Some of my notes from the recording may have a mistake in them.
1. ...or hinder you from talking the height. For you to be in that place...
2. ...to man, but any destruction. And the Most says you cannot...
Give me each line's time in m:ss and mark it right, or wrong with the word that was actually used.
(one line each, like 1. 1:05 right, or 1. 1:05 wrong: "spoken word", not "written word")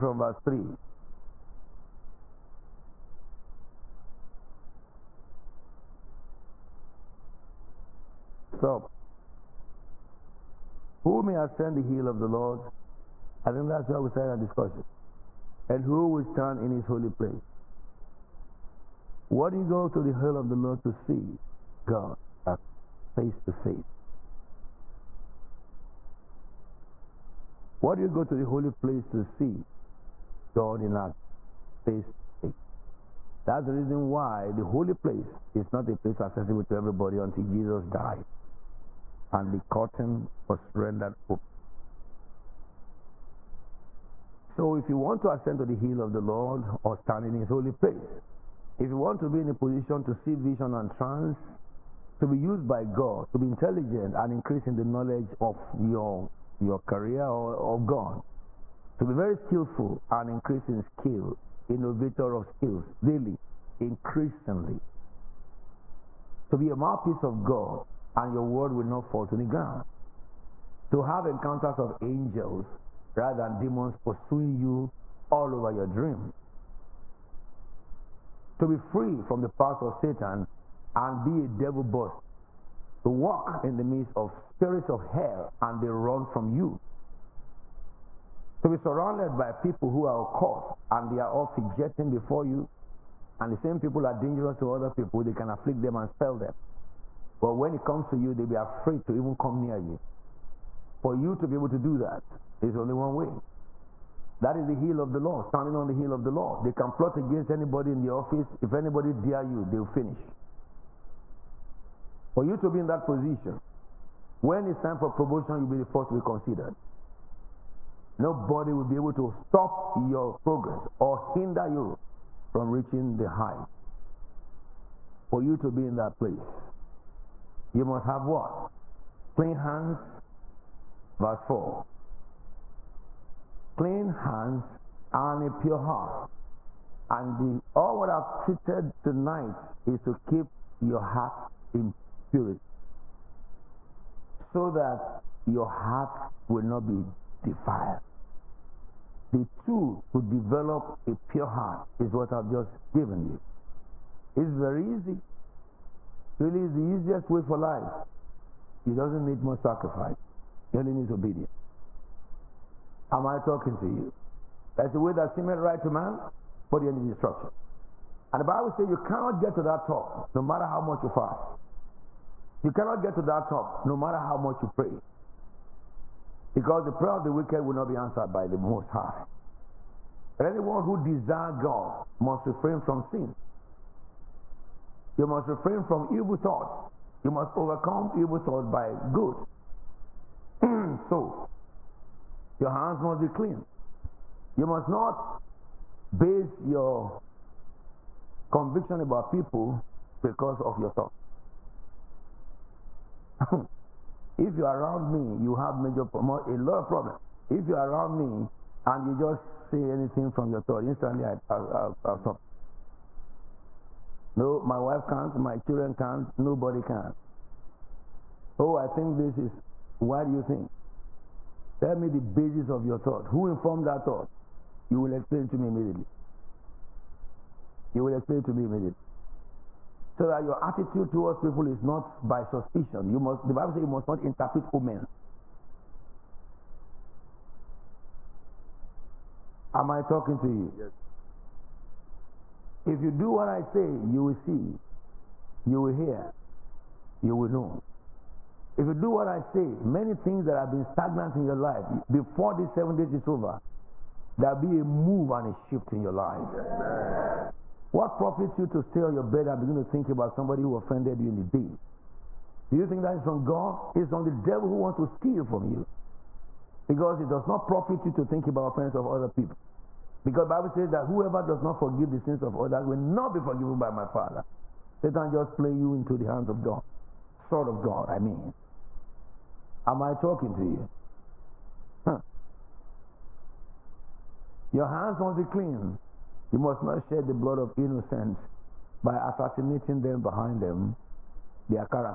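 1. 2:00 wrong: "reaching", not "talking"
2. 2:45 wrong: "Bible", not "Most".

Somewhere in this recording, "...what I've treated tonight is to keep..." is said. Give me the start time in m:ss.
2:17.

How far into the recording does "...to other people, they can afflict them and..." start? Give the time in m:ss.
1:34.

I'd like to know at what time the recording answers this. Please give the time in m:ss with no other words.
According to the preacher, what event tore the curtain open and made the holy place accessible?
0:37.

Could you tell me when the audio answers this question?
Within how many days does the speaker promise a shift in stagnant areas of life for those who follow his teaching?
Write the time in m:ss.
4:12.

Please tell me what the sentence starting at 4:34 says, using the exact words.
Satan just play you into the hands of God.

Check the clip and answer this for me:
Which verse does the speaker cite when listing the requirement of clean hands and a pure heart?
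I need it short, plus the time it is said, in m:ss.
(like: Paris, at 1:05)
verse 4, at 2:11.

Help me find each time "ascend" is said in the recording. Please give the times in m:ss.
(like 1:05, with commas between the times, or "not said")
0:11, 0:45.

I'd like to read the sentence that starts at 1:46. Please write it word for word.
They can plot against anybody in the office.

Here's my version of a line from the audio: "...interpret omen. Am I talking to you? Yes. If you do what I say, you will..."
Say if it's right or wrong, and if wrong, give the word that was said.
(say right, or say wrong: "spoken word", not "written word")
right.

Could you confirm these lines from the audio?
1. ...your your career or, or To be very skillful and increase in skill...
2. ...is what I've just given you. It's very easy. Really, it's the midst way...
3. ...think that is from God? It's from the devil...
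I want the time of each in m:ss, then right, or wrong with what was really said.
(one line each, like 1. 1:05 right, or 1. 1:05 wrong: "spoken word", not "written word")
1. 0:55 right
2. 2:31 wrong: "easiest", not "midst"
3. 4:22 right.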